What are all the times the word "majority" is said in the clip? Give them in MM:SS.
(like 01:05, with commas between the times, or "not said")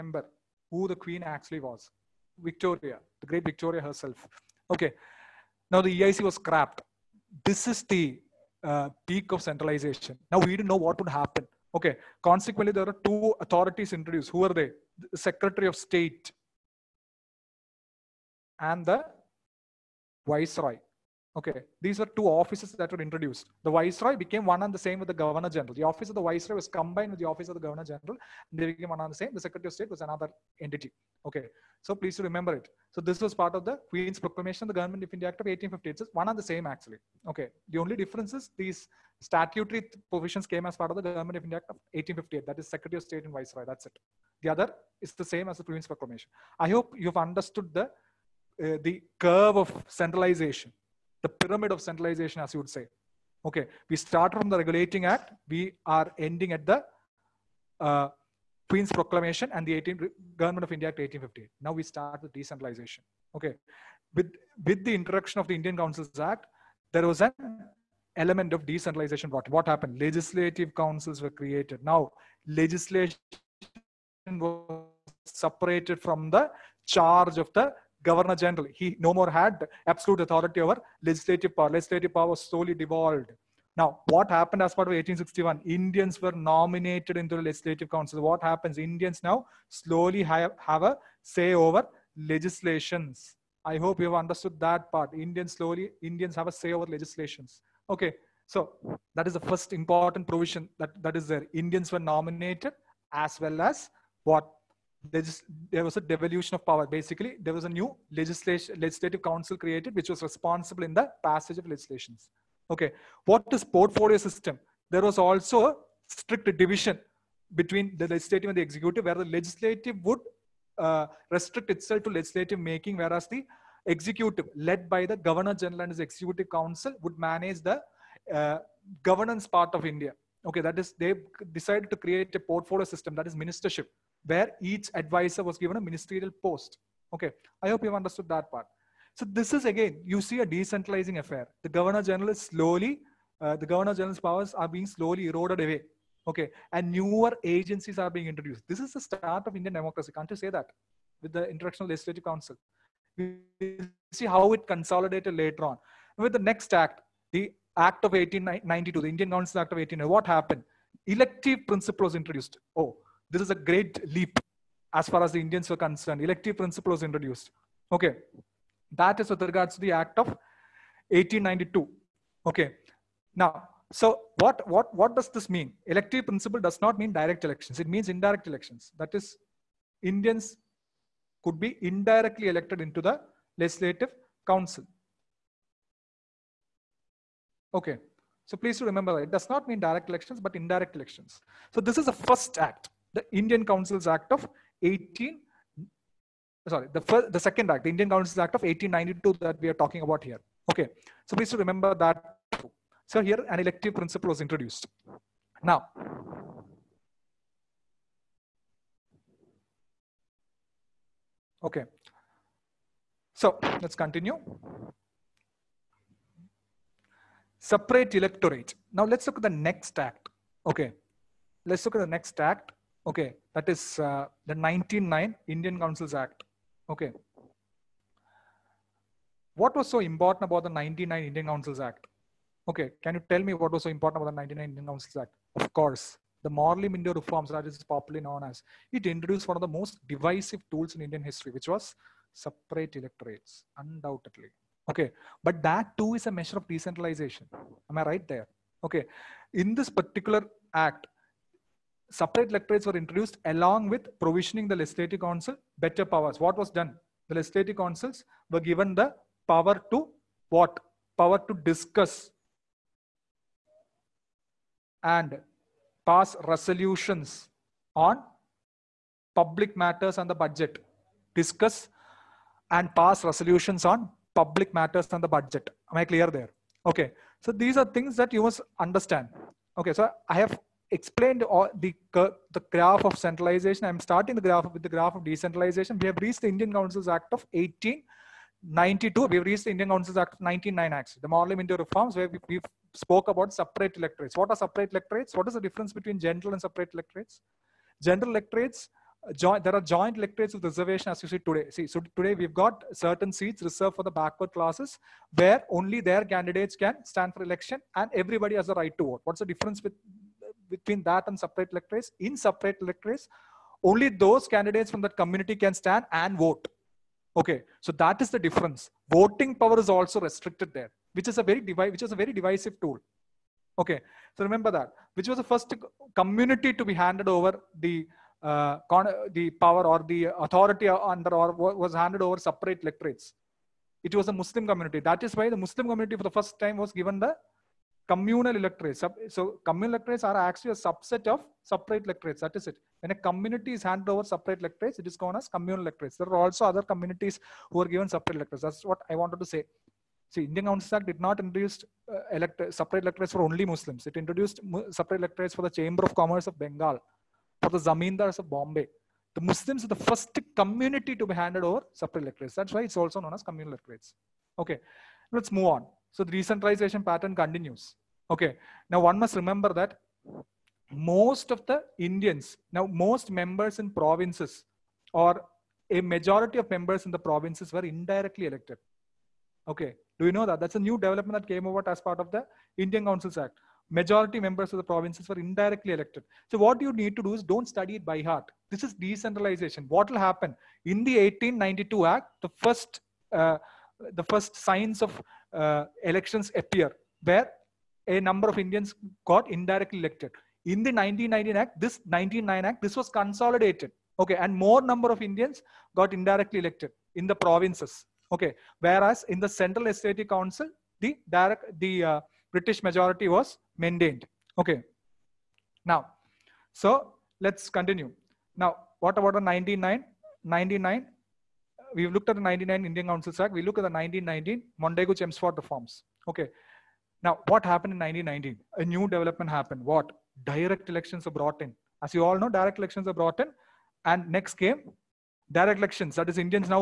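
06:16, 06:23, 06:52.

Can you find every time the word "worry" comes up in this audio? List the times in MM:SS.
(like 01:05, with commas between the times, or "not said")
not said.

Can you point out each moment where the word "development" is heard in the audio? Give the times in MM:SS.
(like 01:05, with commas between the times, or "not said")
06:20, 07:09.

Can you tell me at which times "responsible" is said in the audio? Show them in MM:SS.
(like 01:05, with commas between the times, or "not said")
01:50.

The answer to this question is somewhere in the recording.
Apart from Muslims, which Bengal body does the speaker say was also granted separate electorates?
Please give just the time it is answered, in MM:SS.
05:55.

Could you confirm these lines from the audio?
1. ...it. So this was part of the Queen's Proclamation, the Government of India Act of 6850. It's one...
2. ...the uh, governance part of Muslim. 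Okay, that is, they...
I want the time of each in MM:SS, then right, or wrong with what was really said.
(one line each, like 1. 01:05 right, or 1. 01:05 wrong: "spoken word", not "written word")
1. 00:32 wrong: "1850", not "6850"
2. 02:07 wrong: "India", not "Muslim".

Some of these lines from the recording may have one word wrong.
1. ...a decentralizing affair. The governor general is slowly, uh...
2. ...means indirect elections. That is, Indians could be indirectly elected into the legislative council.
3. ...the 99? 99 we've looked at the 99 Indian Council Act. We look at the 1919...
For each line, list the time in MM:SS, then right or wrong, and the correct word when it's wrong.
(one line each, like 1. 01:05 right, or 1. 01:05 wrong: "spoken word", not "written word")
1. 02:20 right
2. 02:57 right
3. 06:59 right.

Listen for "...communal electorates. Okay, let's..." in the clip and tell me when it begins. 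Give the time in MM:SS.
06:03.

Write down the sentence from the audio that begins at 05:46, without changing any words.
There are also other communities who are given separate electorates.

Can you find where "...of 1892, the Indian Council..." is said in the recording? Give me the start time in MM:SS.
02:38.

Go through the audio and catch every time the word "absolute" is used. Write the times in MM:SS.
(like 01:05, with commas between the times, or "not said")
01:19.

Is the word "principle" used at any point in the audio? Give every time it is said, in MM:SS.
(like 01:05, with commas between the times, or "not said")
02:41, 02:46, 02:56, 03:23.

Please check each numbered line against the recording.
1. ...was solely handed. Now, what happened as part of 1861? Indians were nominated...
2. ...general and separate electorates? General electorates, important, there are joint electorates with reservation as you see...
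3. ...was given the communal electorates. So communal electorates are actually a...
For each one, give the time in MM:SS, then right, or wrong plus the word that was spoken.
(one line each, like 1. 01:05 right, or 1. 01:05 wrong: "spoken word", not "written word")
1. 01:22 wrong: "devolved", not "handed"
2. 04:56 wrong: "joint", not "important"
3. 05:36 right.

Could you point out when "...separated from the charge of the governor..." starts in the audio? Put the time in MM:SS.
01:15.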